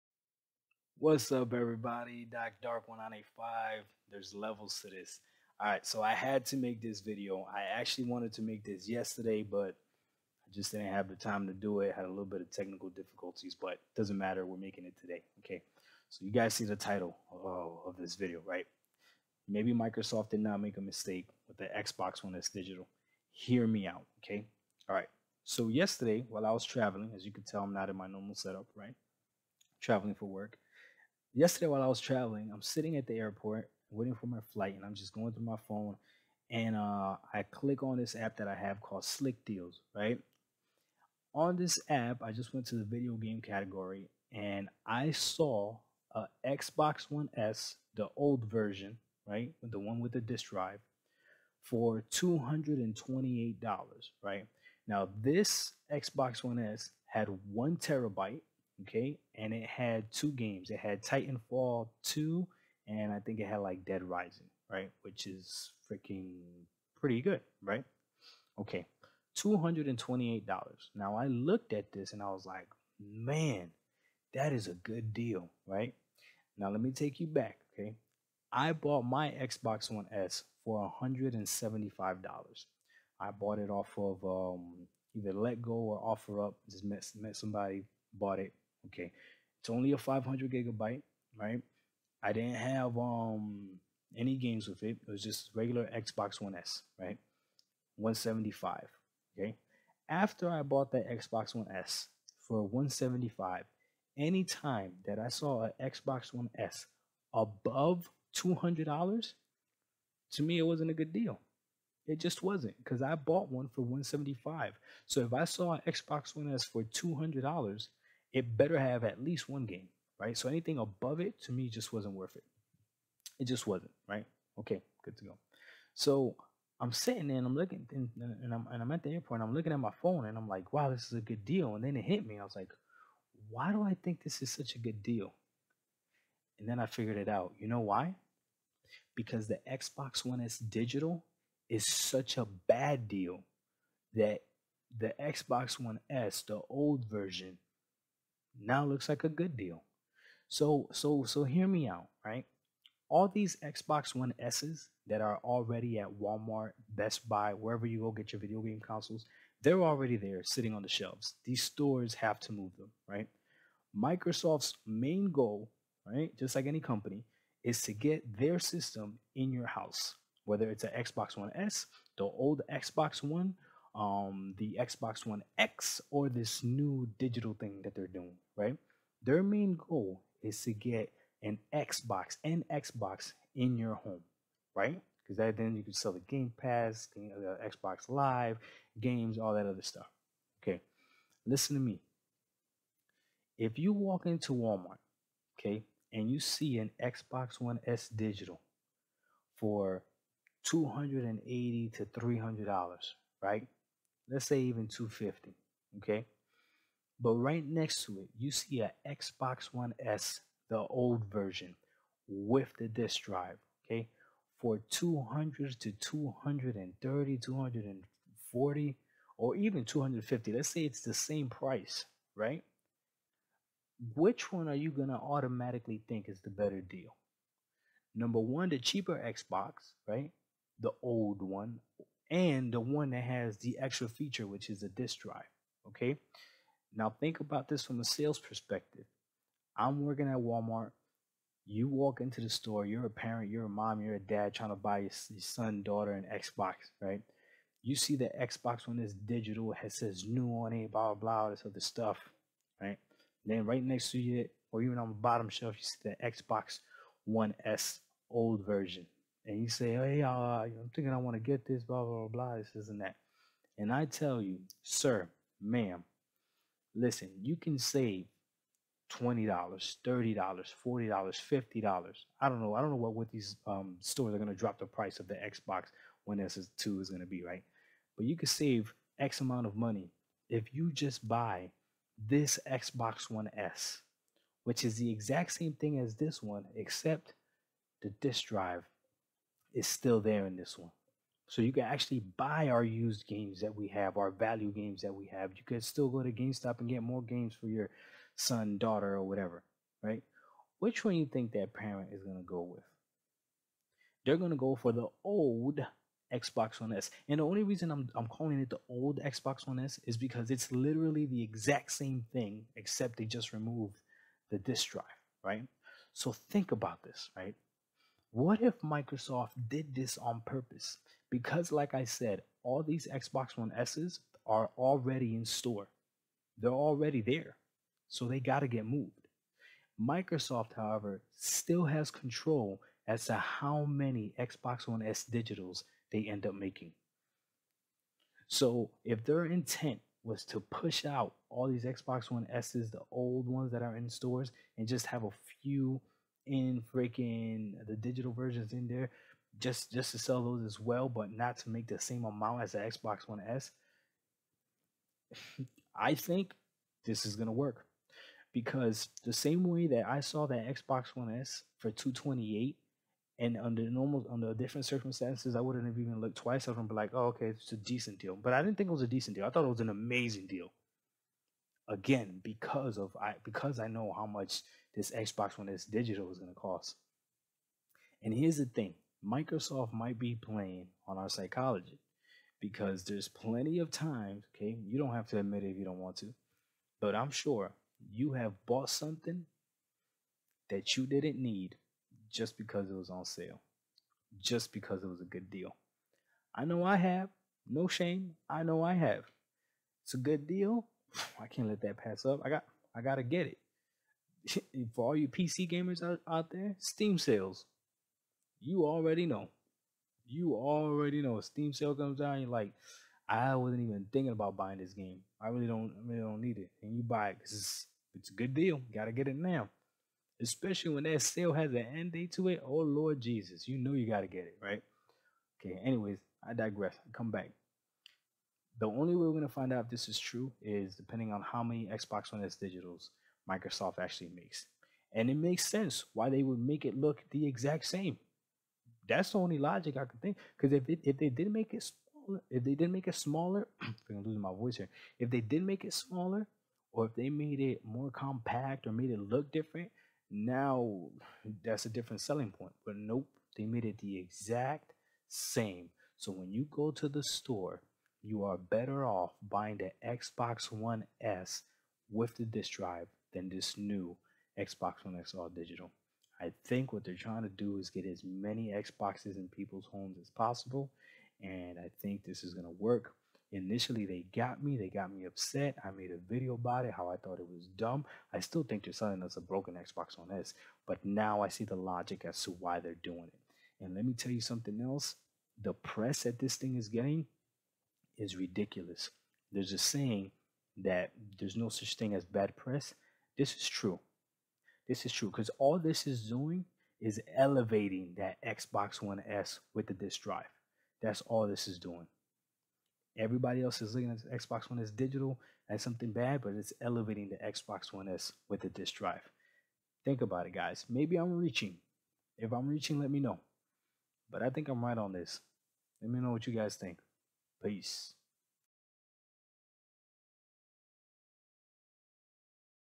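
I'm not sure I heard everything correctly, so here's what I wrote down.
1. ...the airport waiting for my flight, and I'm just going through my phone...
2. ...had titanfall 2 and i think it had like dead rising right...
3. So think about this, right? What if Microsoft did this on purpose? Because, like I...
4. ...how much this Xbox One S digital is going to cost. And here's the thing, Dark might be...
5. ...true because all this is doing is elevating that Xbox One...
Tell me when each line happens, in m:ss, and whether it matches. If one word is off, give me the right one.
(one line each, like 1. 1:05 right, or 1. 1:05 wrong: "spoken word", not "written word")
1. 0:33 right
2. 1:00 right
3. 5:16 right
4. 6:14 wrong: "Microsoft", not "Dark"
5. 8:15 right.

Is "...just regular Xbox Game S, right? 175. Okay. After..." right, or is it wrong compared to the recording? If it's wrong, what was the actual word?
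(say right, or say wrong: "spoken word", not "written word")
wrong: "One", not "Game".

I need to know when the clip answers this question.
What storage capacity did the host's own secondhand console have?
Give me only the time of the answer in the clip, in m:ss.
1:29.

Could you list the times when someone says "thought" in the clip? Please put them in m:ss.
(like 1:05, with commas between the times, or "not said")
6:09, 7:57.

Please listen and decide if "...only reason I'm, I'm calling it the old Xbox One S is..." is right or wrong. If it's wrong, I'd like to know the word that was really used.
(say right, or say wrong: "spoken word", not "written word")
right.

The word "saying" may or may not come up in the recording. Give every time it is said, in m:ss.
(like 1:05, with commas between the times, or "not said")
8:09.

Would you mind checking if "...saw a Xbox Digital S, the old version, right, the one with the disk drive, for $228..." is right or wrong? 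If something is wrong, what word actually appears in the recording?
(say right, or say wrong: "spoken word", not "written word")
wrong: "One", not "Digital".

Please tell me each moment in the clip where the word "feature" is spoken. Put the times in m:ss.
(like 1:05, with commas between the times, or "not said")
3:54.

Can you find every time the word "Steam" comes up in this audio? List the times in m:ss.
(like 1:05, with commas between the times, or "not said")
6:46, 6:51.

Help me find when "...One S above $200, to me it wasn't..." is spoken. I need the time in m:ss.
1:46.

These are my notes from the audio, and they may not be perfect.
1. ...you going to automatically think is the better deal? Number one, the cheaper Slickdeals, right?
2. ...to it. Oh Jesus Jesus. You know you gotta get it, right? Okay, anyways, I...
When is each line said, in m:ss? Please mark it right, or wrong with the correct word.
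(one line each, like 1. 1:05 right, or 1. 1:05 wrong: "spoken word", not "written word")
1. 3:44 wrong: "Xbox", not "Slickdeals"
2. 7:02 wrong: "Lord", not "Jesus".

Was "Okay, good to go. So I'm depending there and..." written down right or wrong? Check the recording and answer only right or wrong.
wrong.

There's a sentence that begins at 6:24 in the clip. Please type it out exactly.
You don't have to admit it if you don't want to.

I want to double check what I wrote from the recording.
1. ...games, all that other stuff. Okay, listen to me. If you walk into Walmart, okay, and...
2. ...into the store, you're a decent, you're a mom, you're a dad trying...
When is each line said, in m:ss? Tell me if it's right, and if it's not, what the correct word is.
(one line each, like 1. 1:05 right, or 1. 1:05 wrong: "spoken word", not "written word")
1. 3:08 right
2. 4:02 wrong: "parent", not "decent".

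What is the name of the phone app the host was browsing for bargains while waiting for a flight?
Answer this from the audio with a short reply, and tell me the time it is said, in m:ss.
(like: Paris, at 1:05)
Slickdeals, at 0:39.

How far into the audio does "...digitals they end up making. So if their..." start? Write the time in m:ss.
5:35.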